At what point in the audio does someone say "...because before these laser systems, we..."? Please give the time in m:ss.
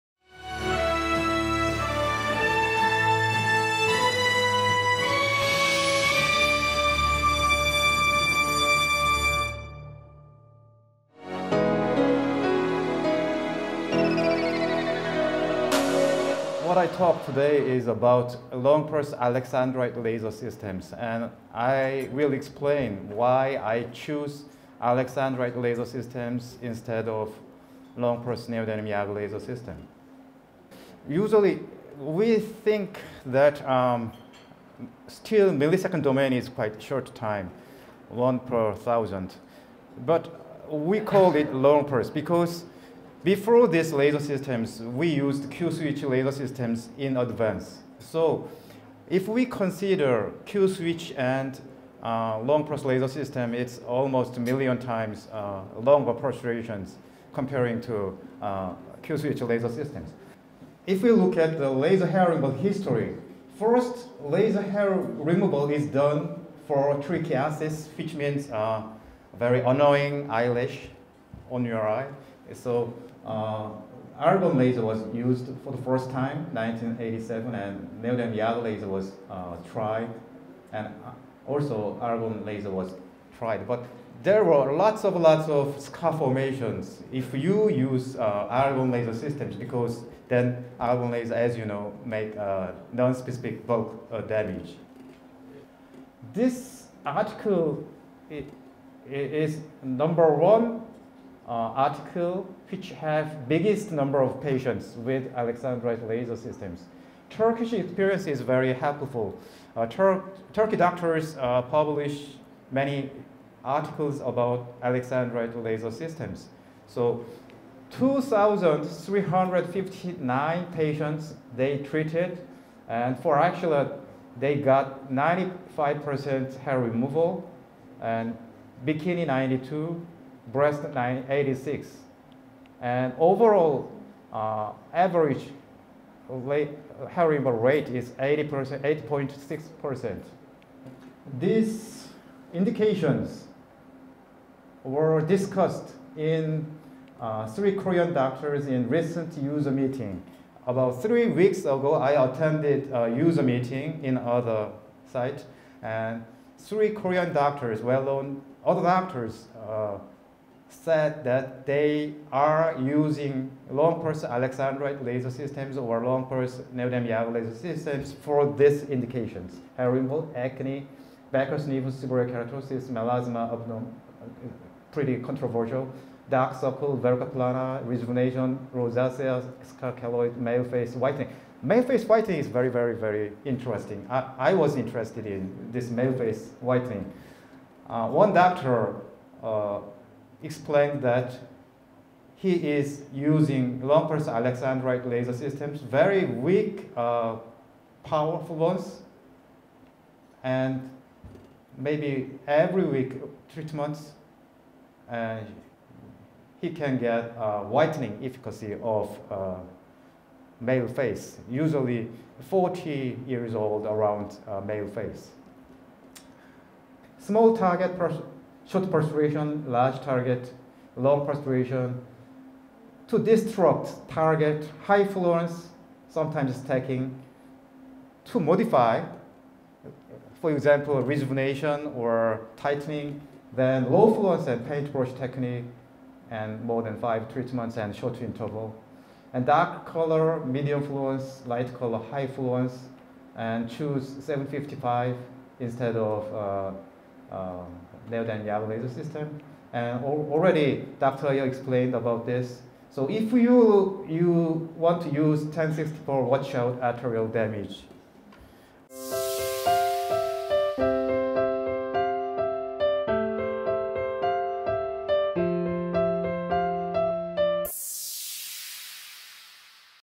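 0:42.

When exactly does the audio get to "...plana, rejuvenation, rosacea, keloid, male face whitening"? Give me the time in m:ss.
2:57.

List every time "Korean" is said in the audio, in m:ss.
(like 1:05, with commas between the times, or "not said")
2:27, 2:36.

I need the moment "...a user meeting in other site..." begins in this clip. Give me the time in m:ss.
2:32.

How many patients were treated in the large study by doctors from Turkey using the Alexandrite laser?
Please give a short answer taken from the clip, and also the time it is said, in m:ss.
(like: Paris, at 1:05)
2,359, at 1:57.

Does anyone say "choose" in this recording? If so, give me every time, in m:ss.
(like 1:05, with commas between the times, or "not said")
0:23, 4:03.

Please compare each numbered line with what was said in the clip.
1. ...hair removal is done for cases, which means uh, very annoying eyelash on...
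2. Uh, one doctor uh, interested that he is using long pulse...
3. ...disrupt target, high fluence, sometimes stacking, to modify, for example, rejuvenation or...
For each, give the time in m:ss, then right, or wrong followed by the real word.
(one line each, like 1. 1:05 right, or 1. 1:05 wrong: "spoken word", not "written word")
1. 1:04 right
2. 3:07 wrong: "explained", not "interested"
3. 3:43 right.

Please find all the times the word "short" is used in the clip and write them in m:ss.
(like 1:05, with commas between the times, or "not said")
0:36, 3:38, 3:57.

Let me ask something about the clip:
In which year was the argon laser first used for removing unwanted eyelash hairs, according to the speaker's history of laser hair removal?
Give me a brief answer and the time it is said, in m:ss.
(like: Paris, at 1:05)
1987, at 1:16.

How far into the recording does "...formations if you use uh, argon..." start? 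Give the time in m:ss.
1:26.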